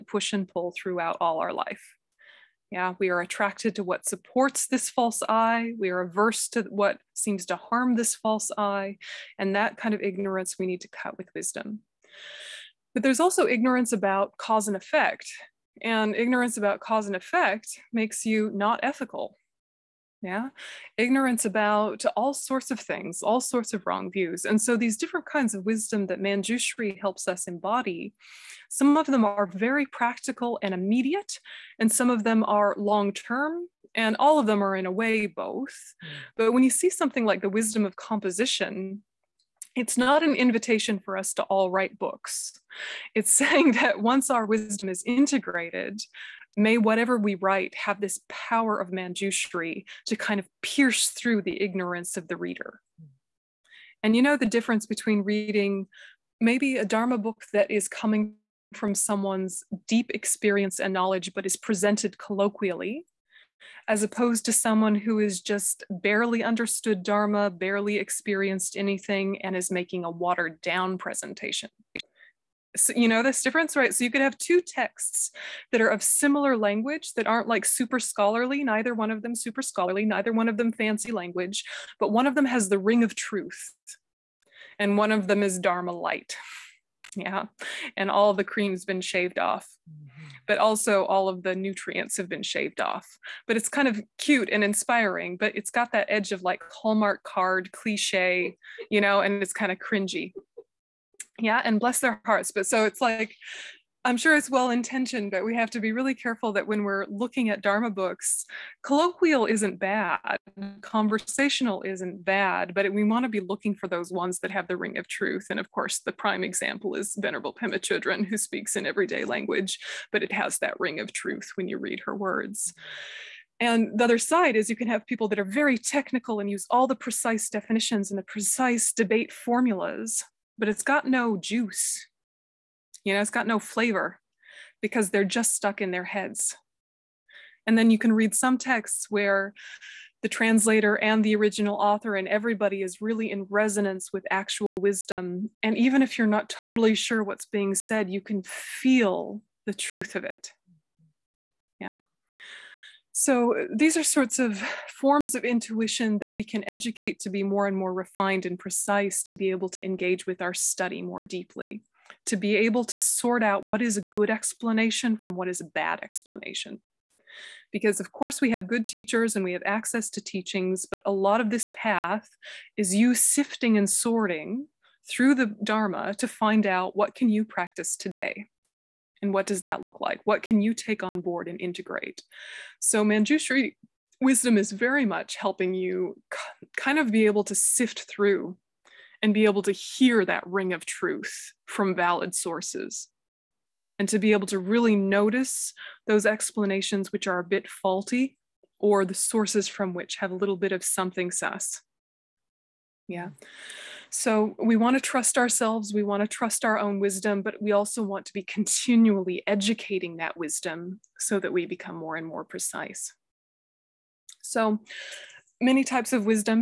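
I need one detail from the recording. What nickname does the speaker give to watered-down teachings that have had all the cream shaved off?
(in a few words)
Dharma light.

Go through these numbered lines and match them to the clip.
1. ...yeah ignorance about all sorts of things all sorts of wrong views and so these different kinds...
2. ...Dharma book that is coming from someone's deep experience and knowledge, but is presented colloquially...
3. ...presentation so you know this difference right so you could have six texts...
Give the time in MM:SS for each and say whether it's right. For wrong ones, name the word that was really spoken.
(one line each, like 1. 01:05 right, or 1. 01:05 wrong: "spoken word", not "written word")
1. 00:20 right
2. 00:56 right
3. 01:10 wrong: "two", not "six".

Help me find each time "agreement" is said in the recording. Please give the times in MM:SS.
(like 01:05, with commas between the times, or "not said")
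not said.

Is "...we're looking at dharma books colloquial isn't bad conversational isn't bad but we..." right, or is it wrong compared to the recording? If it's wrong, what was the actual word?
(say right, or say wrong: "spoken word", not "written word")
right.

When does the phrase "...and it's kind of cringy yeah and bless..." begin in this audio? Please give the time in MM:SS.
01:39.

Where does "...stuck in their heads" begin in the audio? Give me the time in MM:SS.
02:15.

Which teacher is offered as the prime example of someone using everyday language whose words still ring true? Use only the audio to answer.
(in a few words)
Pema Chodron.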